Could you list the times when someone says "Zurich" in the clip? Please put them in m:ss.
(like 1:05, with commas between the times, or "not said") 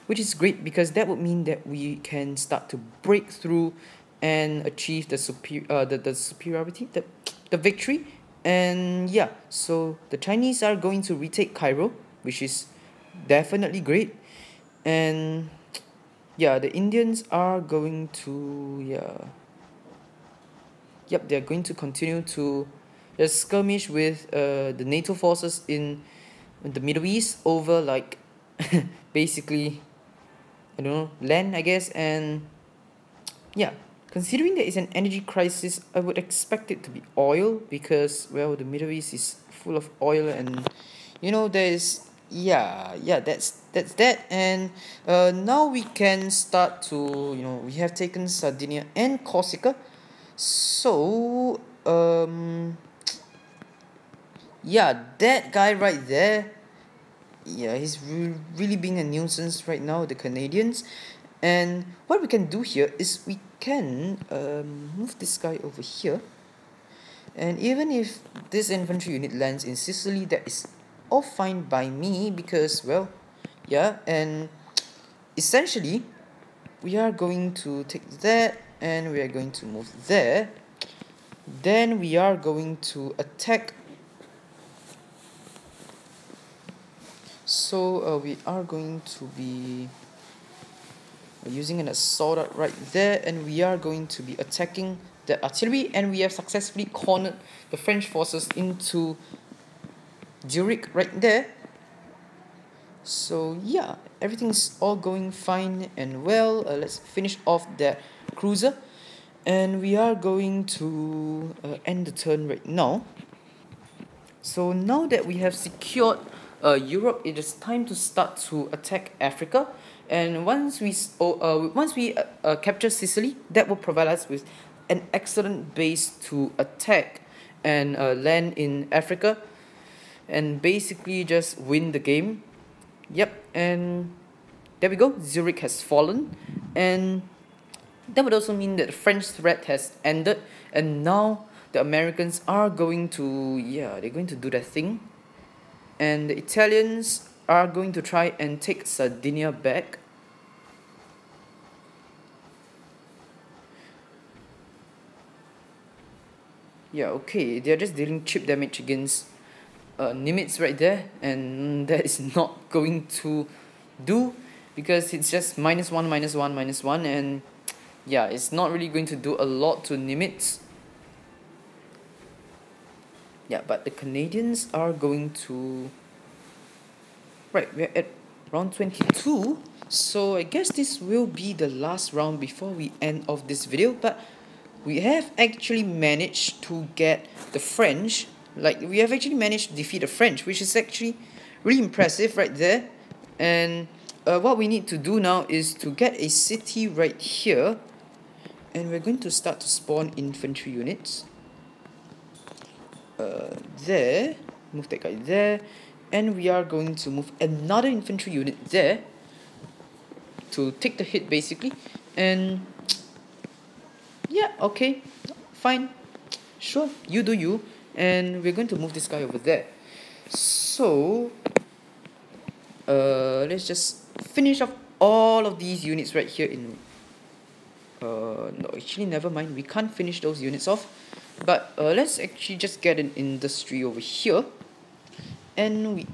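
1:40, 2:15.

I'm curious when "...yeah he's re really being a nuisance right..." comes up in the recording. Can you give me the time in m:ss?
0:57.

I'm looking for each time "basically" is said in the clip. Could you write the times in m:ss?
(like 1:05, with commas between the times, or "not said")
0:29, 2:10, 3:31.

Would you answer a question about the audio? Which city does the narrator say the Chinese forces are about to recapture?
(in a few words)
Cairo.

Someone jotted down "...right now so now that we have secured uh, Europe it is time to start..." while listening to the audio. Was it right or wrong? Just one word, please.
right.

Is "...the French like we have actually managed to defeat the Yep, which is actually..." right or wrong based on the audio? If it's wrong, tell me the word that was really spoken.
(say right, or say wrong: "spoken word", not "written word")
wrong: "French", not "Yep".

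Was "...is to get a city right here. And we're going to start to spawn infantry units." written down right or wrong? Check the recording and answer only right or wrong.
right.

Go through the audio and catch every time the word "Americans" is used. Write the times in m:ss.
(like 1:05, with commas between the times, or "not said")
2:21.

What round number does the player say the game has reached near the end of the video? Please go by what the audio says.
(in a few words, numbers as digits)
22.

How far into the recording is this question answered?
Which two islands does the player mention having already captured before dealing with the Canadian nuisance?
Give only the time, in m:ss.
0:48.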